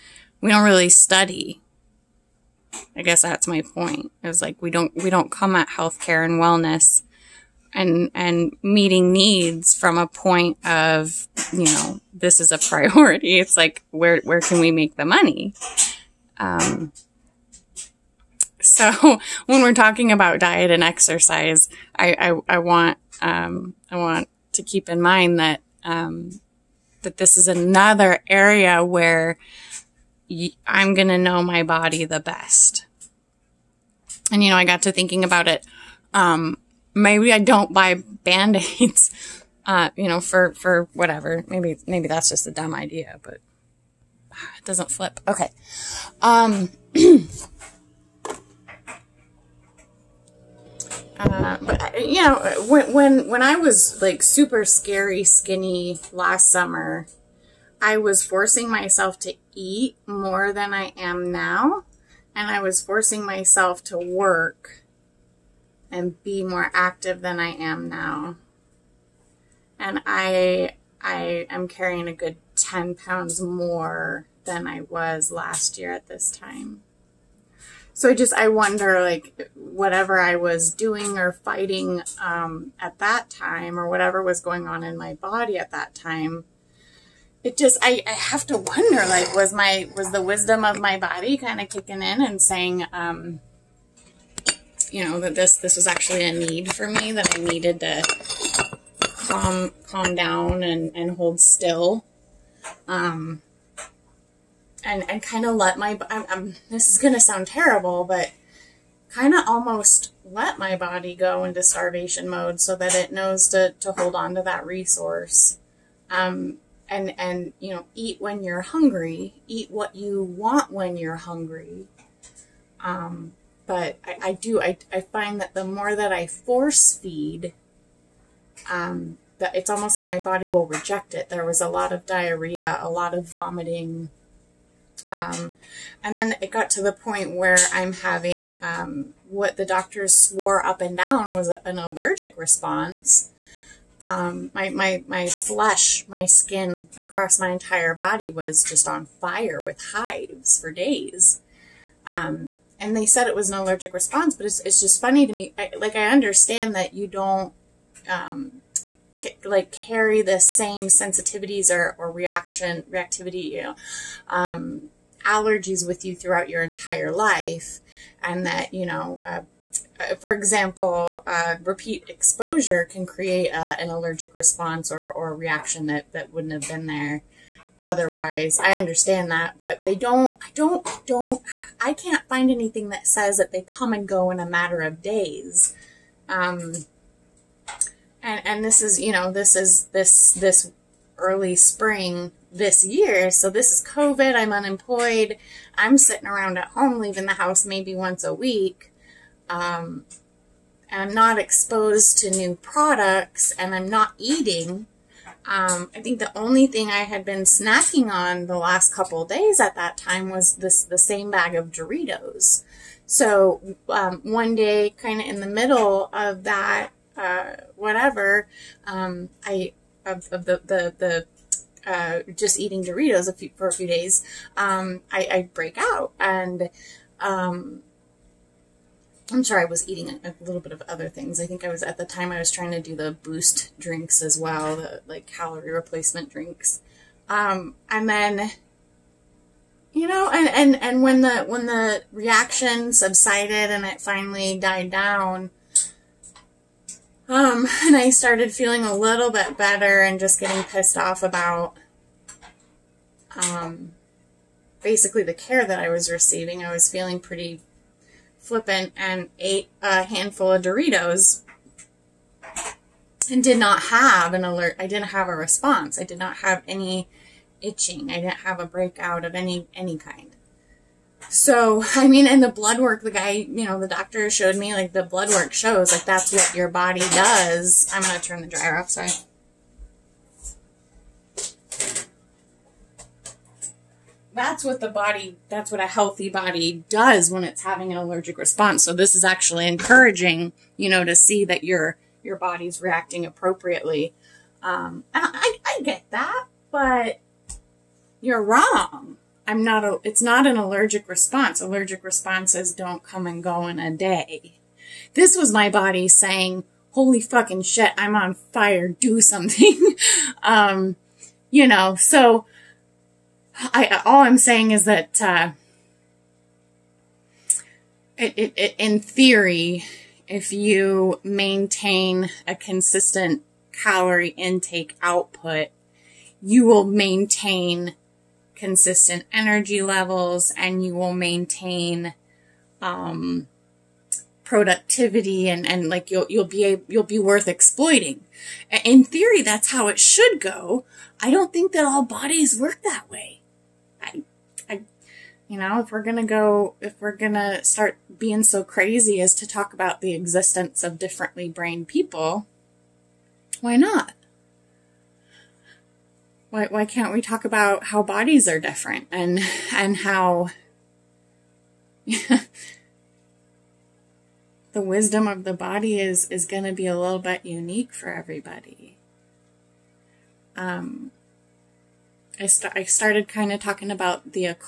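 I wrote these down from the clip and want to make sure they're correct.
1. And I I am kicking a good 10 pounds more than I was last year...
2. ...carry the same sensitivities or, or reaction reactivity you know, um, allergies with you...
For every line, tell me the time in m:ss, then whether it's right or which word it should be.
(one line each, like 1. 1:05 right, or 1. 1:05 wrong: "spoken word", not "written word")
1. 1:09 wrong: "carrying", not "kicking"
2. 2:39 right.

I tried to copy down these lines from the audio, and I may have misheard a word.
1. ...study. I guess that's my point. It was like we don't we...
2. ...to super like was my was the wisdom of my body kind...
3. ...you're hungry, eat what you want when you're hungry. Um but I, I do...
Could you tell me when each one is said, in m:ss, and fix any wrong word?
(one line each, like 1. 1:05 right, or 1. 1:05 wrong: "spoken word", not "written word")
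1. 0:00 right
2. 1:28 wrong: "wonder", not "super"
3. 1:58 right.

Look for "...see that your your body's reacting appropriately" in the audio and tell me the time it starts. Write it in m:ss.
4:51.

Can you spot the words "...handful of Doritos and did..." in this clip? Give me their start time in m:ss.
4:20.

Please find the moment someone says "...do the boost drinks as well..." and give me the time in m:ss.
3:52.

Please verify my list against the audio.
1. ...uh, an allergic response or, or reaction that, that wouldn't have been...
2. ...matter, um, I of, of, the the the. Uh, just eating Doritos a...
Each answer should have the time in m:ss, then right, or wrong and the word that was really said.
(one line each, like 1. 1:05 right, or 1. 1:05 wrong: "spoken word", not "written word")
1. 2:53 right
2. 3:37 wrong: "whatever", not "matter".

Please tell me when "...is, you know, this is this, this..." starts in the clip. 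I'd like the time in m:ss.
3:08.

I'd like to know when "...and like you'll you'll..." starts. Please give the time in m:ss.
5:35.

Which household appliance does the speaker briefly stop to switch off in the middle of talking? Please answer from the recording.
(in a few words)
dryer.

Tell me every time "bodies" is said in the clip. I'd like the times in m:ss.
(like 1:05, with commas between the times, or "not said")
5:42, 5:58.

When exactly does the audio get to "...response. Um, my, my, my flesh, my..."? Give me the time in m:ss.
2:22.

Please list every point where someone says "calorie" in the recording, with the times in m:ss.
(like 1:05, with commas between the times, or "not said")
3:55, 5:23.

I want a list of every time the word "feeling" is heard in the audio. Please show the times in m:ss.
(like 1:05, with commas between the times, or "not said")
4:08, 4:16.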